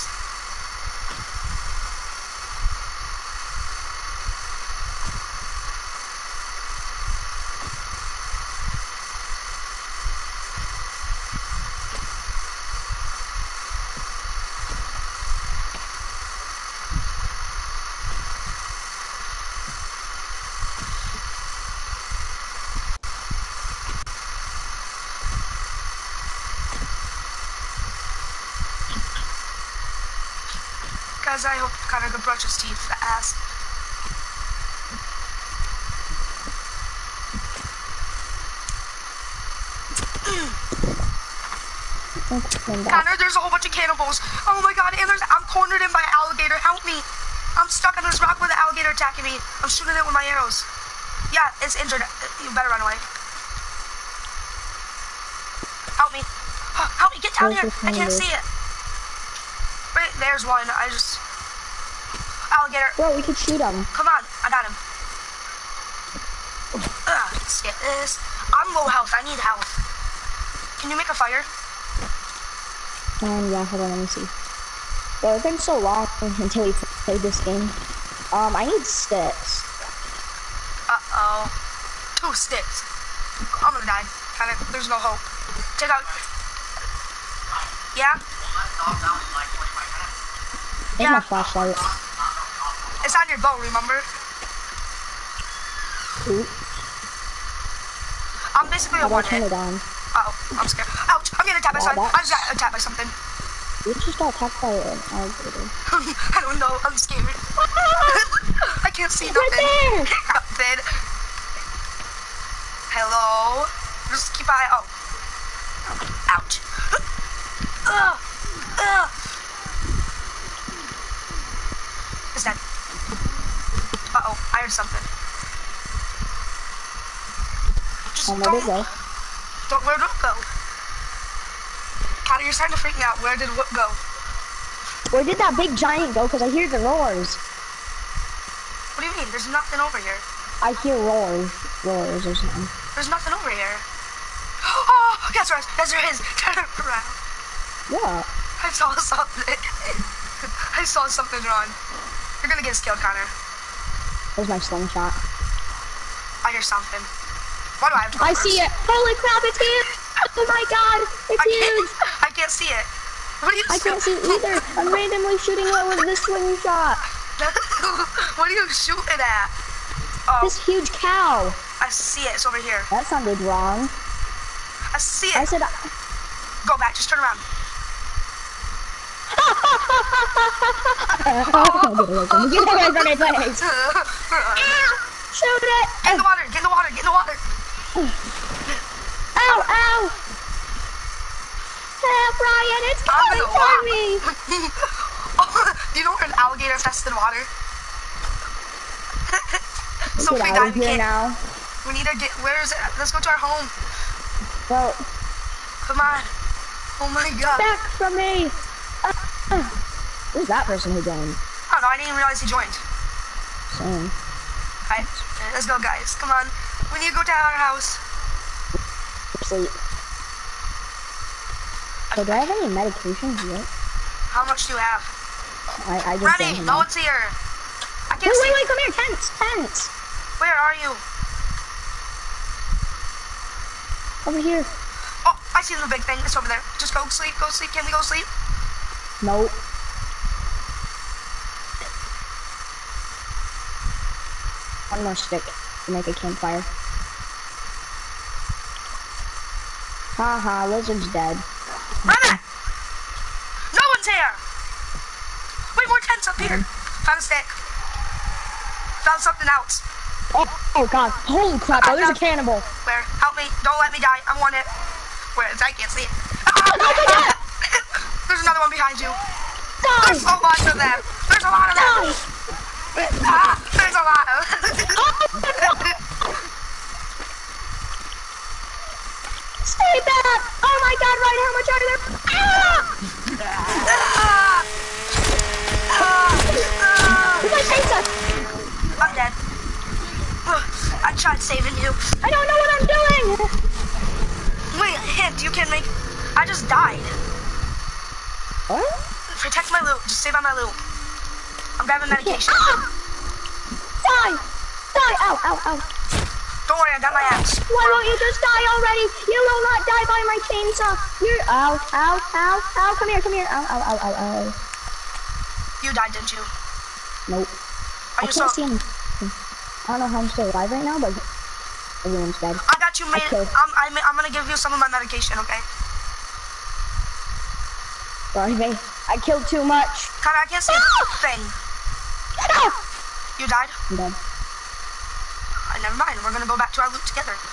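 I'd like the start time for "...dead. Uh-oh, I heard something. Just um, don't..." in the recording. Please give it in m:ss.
2:02.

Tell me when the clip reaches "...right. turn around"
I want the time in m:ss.
2:25.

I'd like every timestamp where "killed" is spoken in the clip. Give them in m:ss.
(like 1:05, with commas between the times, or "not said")
2:32, 5:29.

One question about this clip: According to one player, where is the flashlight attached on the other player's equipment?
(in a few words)
On your bow.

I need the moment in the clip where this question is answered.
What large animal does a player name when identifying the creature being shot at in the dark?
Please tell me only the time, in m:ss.
2:51.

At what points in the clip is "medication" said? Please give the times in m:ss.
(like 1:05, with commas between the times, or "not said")
3:42, 5:02, 5:24.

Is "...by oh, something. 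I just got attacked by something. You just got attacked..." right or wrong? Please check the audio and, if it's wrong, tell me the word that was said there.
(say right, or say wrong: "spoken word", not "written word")
right.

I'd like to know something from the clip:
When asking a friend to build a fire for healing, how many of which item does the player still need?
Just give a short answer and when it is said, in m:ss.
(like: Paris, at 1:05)
2 sticks, at 1:22.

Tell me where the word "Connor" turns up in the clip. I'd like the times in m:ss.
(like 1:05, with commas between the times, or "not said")
0:31, 0:42, 2:12, 2:32, 5:30.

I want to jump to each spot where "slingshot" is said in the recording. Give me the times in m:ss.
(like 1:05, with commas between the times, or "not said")
2:34, 2:46.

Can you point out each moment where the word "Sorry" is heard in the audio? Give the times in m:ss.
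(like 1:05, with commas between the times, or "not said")
3:33, 5:28.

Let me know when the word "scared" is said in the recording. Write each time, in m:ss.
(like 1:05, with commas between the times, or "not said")
1:40, 1:46.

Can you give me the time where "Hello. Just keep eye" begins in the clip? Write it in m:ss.
1:52.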